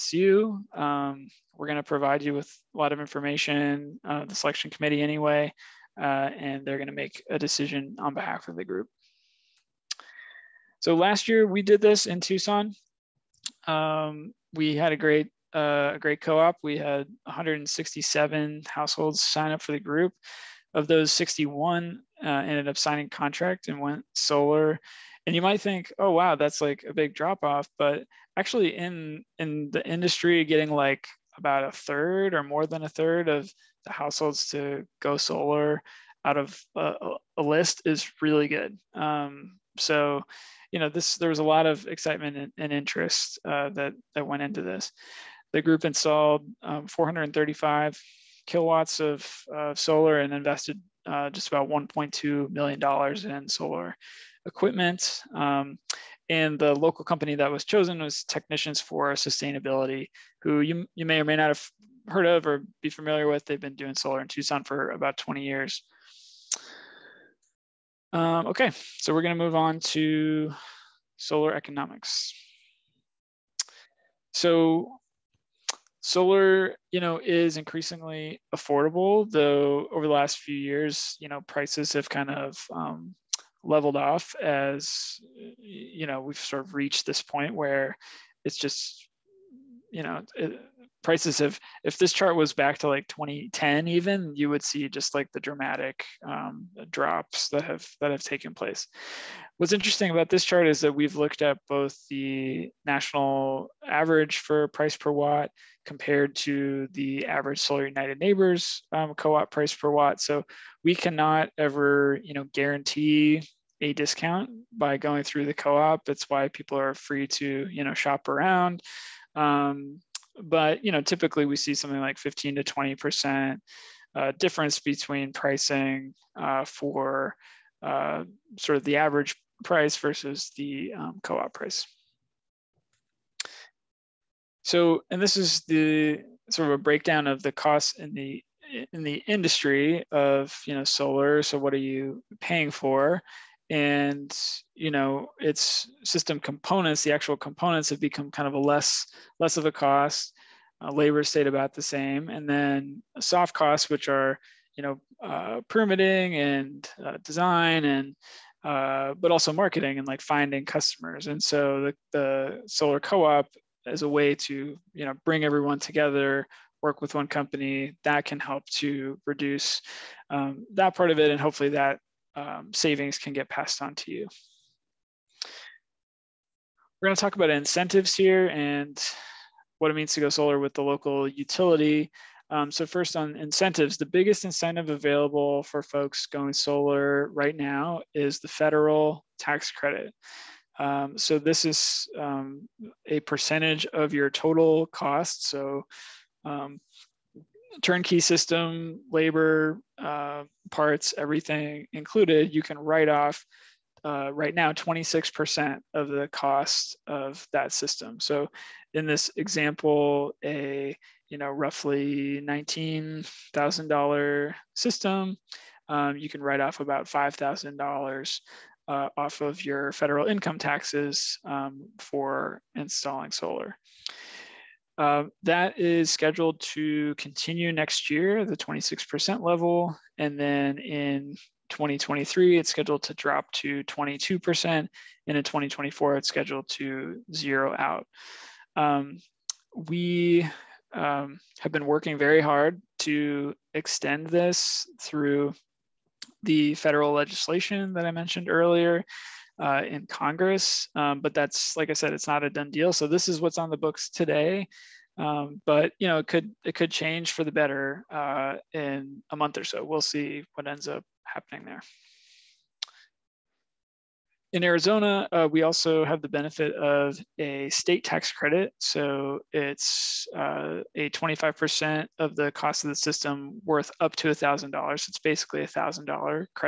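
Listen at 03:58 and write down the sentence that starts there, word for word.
Um, we um, have been working very hard to extend this through the federal legislation that I mentioned earlier, uh, in Congress.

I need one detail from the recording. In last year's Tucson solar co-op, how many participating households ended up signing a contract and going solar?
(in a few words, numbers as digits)
61.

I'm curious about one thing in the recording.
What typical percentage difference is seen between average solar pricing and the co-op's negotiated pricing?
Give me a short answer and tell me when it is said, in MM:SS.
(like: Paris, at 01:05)
15 to 20 percent, at 02:02.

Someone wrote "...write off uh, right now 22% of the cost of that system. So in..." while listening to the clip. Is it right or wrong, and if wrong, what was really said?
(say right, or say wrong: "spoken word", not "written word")
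wrong: "26", not "22".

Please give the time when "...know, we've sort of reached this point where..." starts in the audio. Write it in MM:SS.
01:26.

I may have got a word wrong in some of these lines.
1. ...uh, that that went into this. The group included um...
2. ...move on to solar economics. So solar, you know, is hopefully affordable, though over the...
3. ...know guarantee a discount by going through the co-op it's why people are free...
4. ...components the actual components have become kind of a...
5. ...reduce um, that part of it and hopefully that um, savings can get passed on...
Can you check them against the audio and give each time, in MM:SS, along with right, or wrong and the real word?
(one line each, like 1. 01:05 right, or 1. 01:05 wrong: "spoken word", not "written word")
1. 00:43 wrong: "installed", not "included"
2. 01:09 wrong: "increasingly", not "hopefully"
3. 01:52 right
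4. 02:26 right
5. 02:49 right.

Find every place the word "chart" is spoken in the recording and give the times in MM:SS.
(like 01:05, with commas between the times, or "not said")
01:32, 01:40.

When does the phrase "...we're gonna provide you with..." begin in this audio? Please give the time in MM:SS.
00:01.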